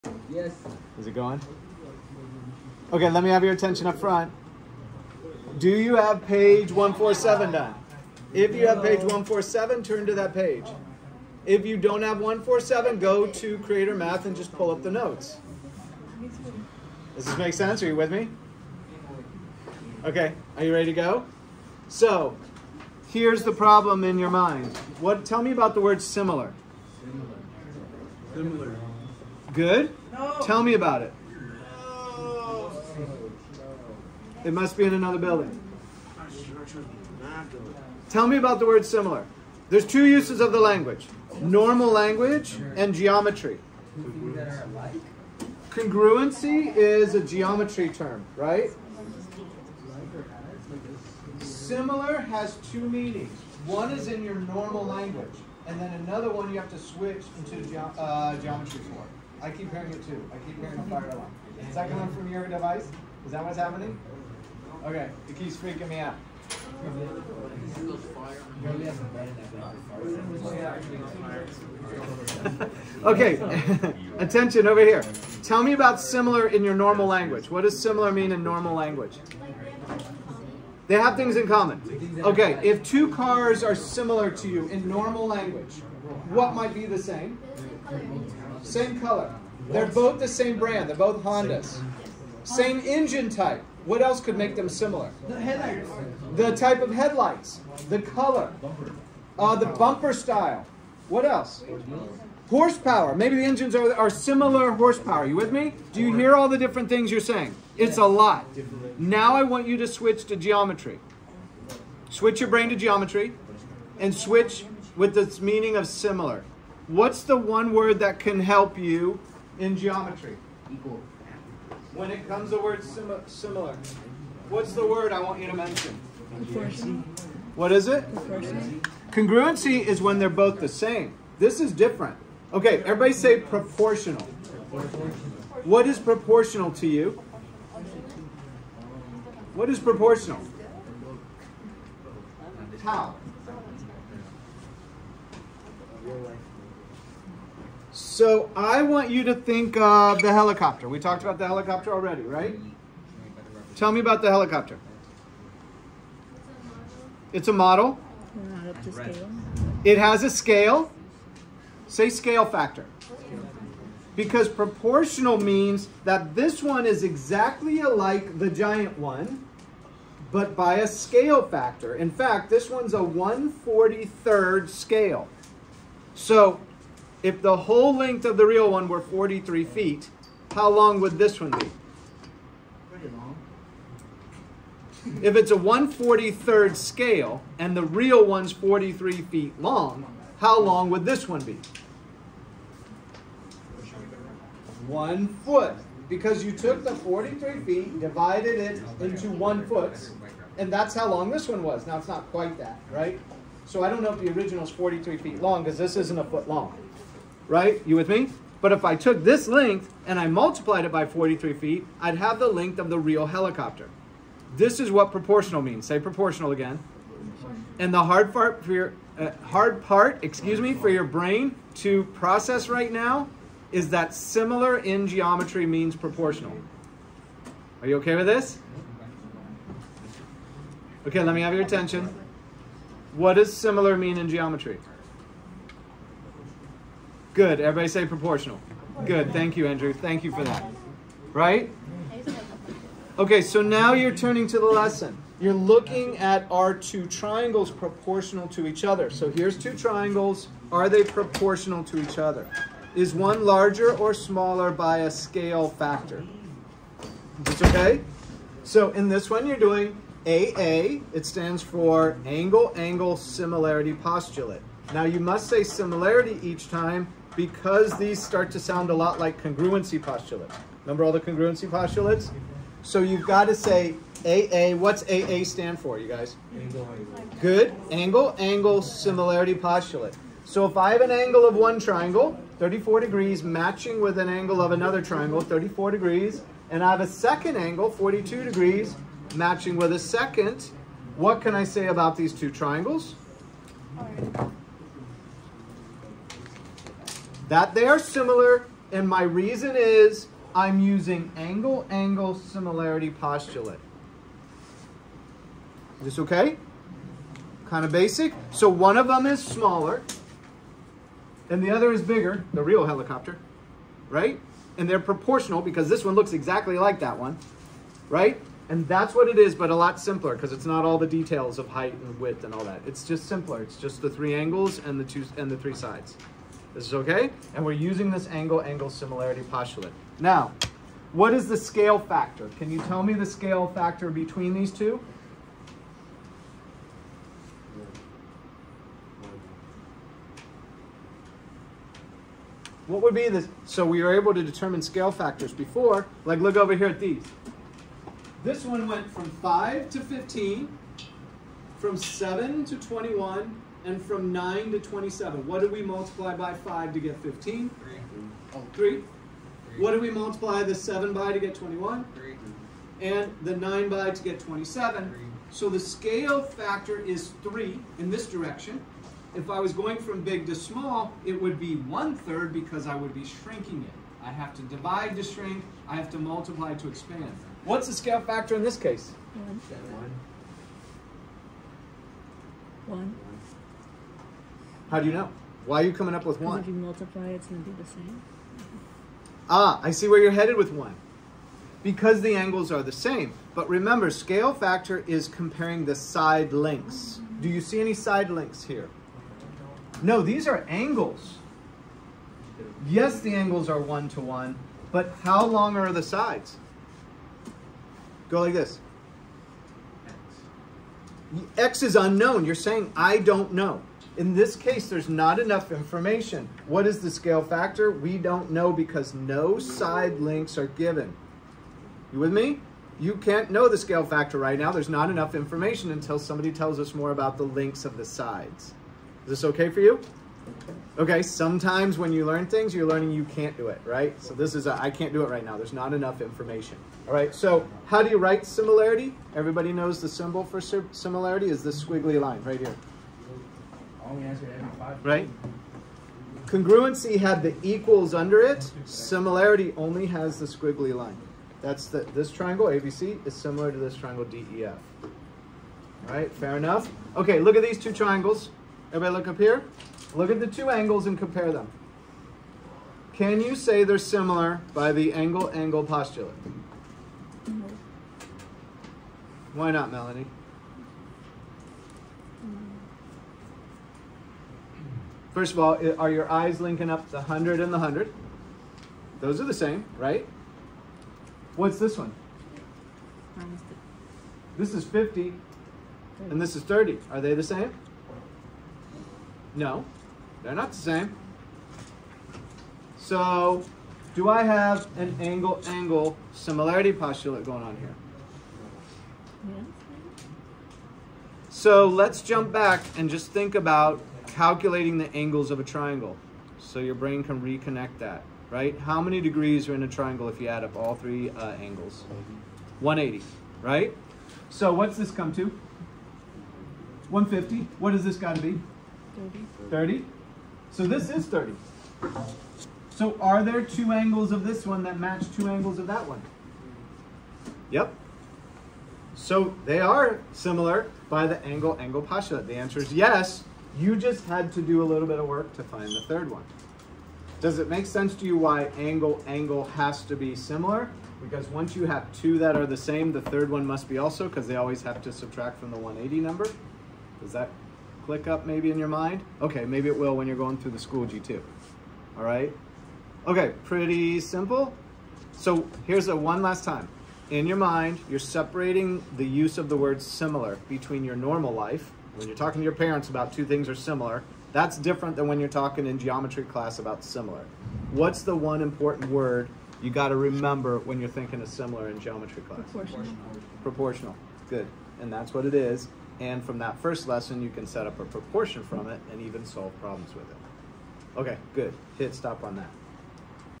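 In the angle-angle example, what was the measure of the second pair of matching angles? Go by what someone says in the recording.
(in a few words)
42 degrees.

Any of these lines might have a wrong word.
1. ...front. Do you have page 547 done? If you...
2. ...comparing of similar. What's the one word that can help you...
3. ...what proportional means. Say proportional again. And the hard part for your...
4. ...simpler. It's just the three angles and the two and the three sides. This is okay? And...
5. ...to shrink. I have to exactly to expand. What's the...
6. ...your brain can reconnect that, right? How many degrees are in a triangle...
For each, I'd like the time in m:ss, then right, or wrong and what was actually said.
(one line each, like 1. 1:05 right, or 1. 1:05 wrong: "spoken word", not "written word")
1. 0:03 wrong: "147", not "547"
2. 1:55 wrong: "meaning", not "comparing"
3. 3:34 right
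4. 5:23 right
5. 6:15 wrong: "multiply", not "exactly"
6. 8:26 right.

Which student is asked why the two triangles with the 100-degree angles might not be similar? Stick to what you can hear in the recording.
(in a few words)
Melanie.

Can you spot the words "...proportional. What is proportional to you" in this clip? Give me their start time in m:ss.
2:13.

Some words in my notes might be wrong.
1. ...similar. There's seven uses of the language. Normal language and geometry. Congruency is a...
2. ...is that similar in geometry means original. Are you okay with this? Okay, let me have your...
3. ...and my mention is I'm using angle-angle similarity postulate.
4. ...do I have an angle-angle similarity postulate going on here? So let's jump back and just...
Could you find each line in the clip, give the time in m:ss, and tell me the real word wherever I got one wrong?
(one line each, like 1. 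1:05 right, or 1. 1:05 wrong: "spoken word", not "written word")
1. 0:38 wrong: "two", not "seven"
2. 3:43 wrong: "proportional", not "original"
3. 4:58 wrong: "reason", not "mention"
4. 8:14 right.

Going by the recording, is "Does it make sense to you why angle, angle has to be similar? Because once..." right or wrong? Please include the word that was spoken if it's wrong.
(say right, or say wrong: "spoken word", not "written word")
right.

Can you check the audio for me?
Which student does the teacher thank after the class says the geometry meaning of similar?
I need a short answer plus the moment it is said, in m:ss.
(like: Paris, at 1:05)
Andrew, at 3:59.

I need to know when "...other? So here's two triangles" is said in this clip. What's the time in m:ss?
4:08.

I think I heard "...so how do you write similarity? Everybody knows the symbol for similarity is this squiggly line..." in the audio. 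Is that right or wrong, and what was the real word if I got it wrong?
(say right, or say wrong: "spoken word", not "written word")
right.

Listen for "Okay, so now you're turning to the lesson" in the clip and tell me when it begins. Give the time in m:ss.
4:03.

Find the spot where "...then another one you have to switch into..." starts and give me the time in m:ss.
0:55.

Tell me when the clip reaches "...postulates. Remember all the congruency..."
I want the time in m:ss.
4:30.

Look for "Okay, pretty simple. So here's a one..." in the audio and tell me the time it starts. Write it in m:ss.
9:13.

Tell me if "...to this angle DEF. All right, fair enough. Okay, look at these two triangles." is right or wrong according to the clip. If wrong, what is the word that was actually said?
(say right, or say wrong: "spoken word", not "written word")
wrong: "triangle", not "angle".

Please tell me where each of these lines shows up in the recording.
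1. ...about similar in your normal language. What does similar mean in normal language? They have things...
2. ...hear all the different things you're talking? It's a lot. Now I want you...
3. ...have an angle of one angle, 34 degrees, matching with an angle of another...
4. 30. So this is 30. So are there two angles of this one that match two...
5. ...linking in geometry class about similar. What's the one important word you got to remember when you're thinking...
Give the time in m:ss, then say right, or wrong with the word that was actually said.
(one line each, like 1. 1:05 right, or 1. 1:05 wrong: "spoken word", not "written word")
1. 1:15 right
2. 1:46 wrong: "saying", not "talking"
3. 4:40 wrong: "triangle", not "angle"
4. 8:39 right
5. 9:25 wrong: "talking", not "linking".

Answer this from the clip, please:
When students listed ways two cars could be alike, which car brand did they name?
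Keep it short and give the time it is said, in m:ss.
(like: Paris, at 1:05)
Hondas, at 1:31.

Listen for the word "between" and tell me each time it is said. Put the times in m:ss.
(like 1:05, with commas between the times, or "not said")
5:34, 9:20.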